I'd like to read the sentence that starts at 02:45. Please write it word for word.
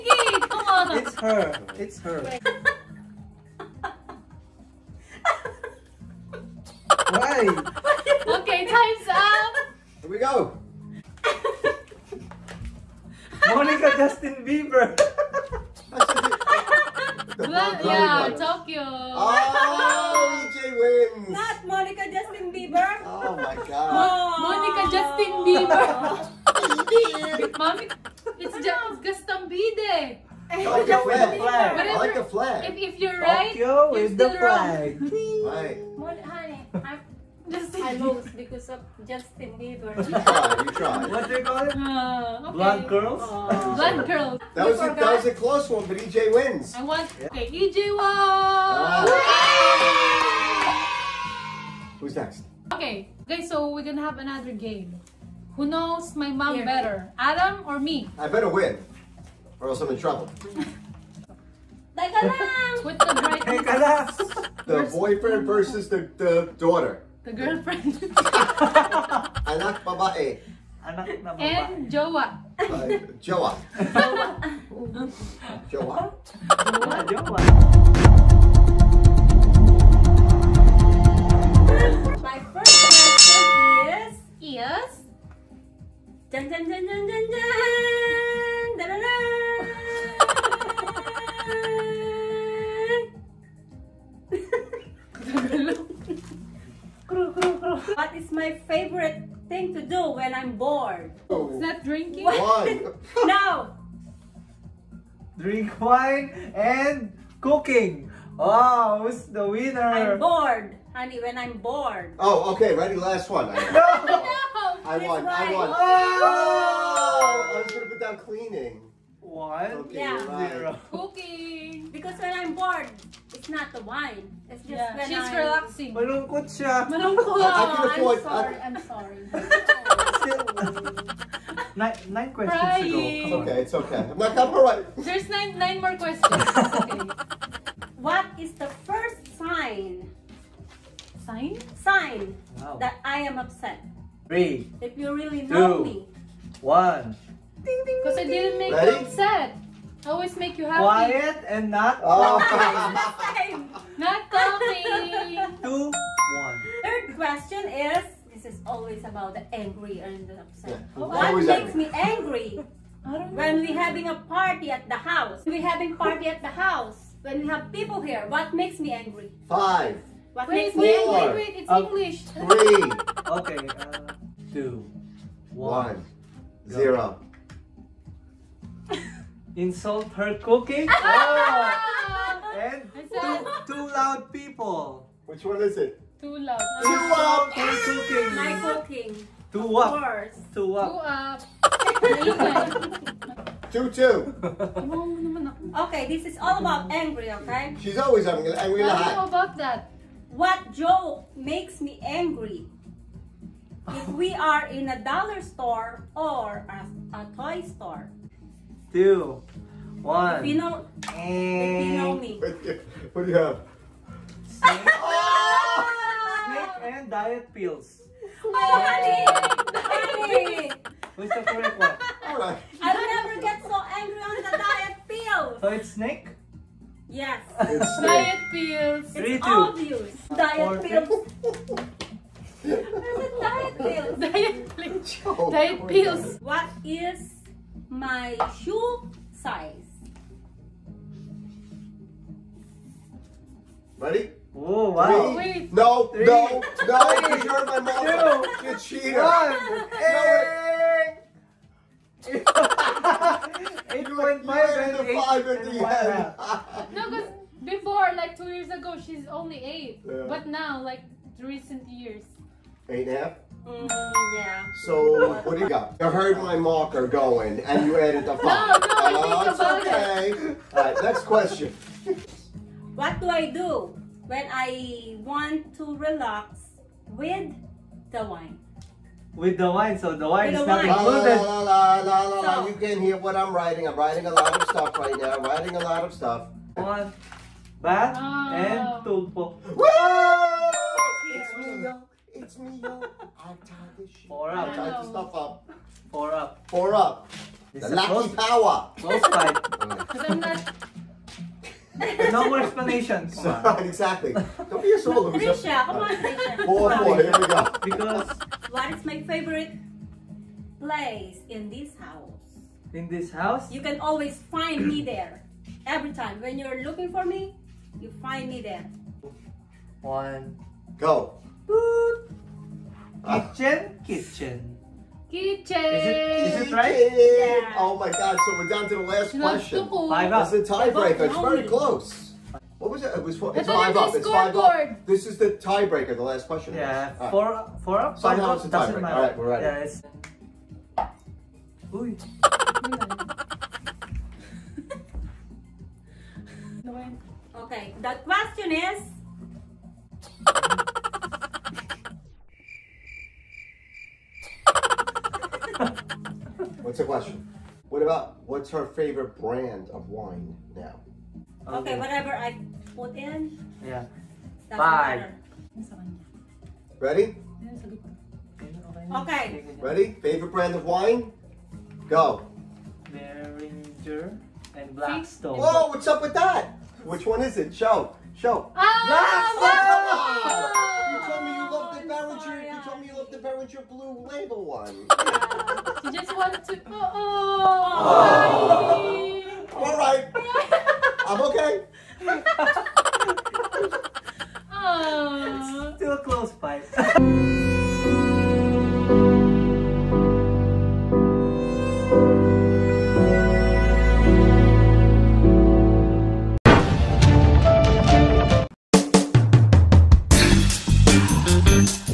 We having party at the house.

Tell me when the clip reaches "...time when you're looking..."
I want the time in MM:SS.
05:16.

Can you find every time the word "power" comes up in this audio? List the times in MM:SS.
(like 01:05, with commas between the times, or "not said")
04:58.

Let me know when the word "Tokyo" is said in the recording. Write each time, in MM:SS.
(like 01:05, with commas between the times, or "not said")
00:18, 00:33.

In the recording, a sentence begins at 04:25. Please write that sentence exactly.
You heard my marker going, and you added the 5.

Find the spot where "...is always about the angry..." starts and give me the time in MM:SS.
02:38.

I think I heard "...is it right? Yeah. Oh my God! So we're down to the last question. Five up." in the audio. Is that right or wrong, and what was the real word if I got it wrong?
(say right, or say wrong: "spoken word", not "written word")
right.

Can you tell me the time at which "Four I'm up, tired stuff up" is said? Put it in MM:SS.
04:54.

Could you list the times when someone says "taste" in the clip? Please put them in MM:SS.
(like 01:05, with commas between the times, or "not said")
not said.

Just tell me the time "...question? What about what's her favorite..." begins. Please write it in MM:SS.
05:57.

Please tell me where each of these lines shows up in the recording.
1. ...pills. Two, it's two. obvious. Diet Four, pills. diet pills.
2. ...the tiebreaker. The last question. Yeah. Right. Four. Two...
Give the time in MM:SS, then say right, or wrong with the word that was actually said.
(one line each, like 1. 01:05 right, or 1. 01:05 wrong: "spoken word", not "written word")
1. 03:48 wrong: "Three", not "Two"
2. 05:35 wrong: "Four", not "Two".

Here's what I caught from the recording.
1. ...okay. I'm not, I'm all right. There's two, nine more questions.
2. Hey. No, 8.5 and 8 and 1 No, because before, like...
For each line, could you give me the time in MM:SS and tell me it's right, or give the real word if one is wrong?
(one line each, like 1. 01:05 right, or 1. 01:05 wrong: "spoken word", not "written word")
1. 02:13 wrong: "nine", not "two"
2. 04:09 right.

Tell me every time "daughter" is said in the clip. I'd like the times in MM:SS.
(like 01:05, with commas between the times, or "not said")
01:06.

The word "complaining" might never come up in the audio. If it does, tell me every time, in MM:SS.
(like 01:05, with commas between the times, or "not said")
not said.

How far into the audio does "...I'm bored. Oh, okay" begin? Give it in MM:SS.
01:51.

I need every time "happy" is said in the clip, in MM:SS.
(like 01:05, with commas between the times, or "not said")
02:30.